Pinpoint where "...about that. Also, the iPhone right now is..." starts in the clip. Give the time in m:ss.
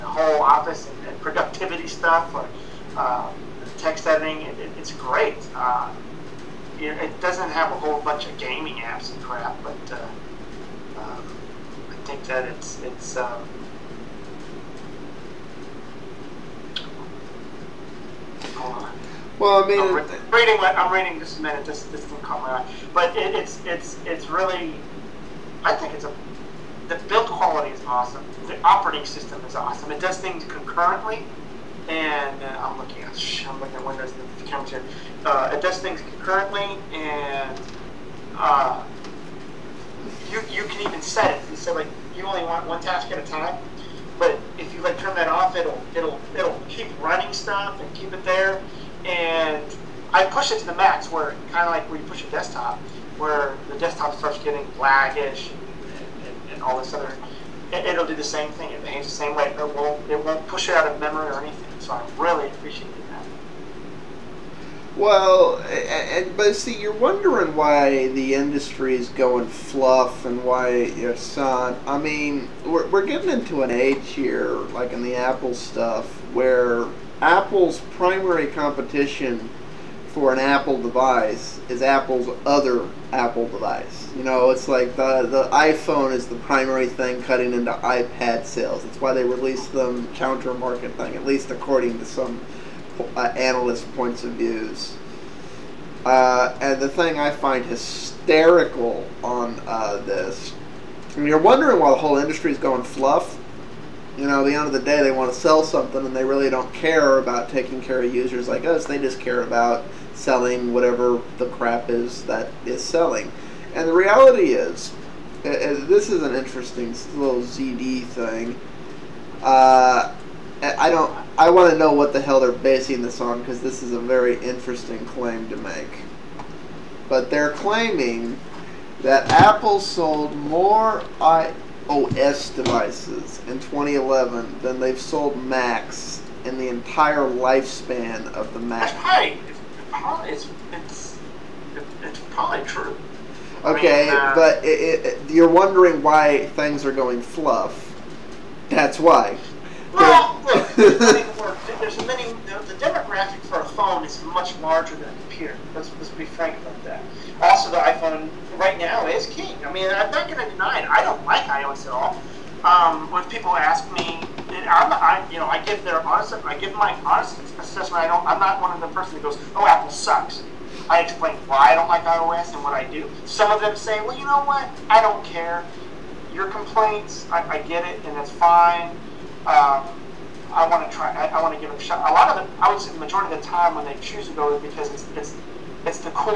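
2:36.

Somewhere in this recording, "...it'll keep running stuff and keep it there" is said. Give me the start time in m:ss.
0:46.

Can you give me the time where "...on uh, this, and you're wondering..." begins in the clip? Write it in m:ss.
1:39.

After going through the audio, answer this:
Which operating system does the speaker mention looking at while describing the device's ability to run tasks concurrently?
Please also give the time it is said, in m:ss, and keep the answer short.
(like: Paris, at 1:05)
Windows 10, at 0:33.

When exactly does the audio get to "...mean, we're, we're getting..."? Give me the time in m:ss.
1:11.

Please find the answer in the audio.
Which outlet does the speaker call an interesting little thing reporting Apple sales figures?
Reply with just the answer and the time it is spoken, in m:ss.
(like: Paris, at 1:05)
ZD, at 1:57.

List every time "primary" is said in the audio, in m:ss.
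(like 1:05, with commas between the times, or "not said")
1:17, 1:26.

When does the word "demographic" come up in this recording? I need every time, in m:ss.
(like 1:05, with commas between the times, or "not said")
2:32.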